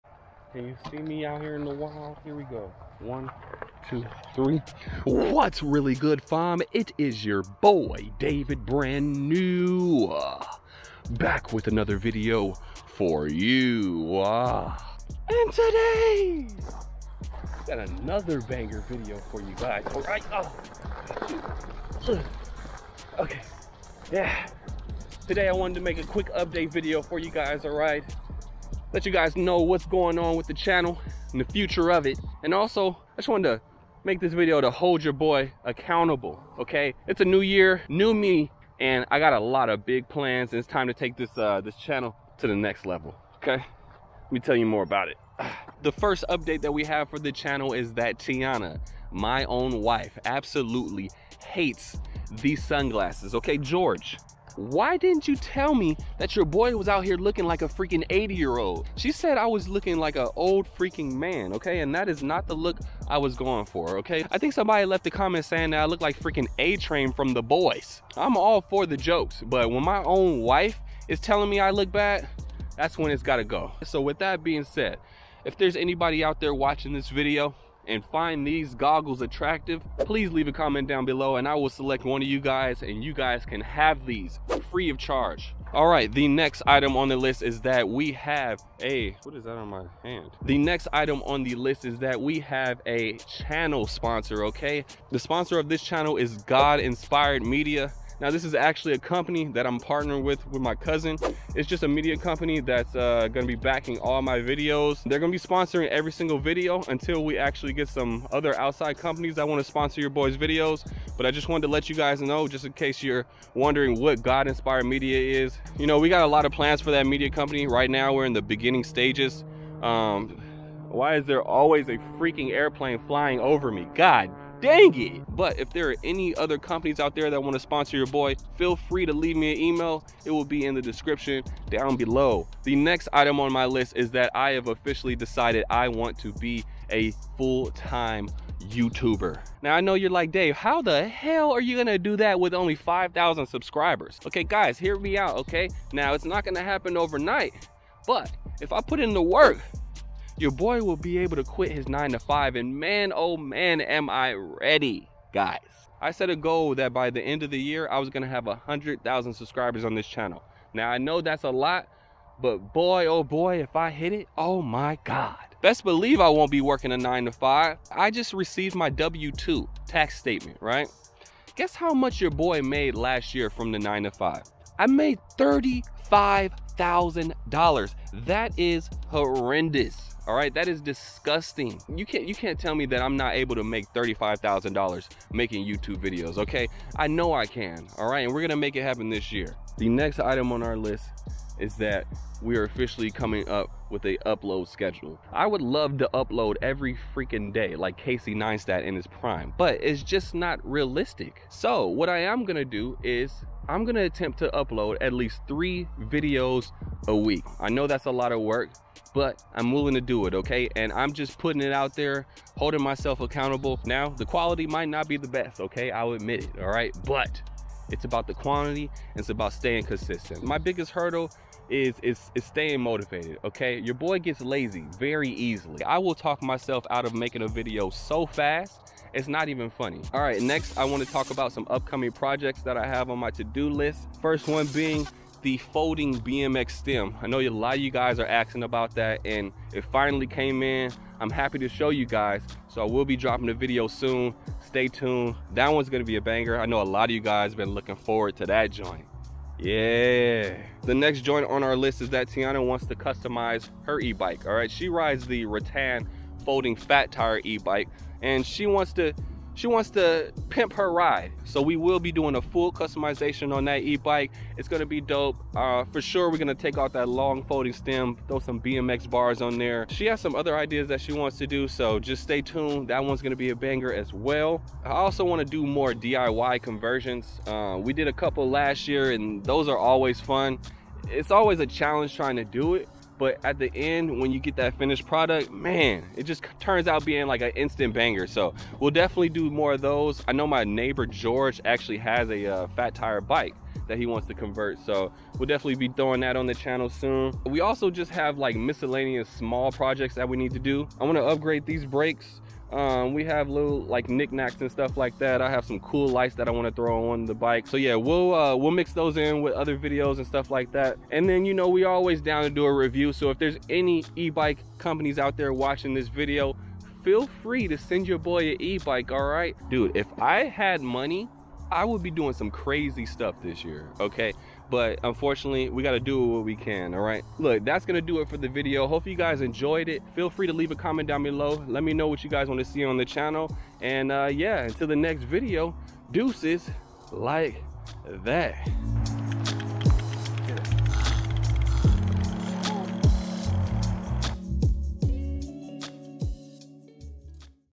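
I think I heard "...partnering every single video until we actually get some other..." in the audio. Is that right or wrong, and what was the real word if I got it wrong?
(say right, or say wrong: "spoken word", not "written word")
wrong: "sponsoring", not "partnering".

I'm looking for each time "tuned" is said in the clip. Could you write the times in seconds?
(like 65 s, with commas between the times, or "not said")
244 s, 272 s.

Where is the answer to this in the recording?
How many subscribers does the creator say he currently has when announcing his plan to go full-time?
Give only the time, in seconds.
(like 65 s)
142 s.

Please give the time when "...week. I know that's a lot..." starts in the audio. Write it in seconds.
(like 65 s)
207 s.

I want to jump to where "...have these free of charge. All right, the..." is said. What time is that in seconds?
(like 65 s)
83 s.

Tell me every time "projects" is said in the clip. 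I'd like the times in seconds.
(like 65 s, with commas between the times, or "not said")
232 s, 299 s.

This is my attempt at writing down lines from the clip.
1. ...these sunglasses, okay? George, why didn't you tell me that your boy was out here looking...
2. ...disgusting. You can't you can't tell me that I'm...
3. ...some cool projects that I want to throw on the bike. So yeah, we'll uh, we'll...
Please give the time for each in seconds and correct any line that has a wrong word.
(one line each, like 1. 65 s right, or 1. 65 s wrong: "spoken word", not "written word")
1. 52 s right
2. 180 s right
3. 305 s wrong: "lights", not "projects".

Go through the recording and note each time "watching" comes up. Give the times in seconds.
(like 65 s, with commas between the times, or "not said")
76 s, 315 s.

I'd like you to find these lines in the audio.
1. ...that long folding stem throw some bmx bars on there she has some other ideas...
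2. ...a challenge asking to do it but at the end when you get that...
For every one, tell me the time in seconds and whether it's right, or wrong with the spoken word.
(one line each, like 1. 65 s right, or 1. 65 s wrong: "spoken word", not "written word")
1. 266 s right
2. 281 s wrong: "trying", not "asking".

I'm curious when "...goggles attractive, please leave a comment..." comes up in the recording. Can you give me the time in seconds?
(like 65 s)
78 s.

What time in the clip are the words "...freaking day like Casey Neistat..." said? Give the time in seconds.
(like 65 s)
197 s.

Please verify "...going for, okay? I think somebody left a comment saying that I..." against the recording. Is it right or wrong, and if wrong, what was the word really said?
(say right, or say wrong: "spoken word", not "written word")
right.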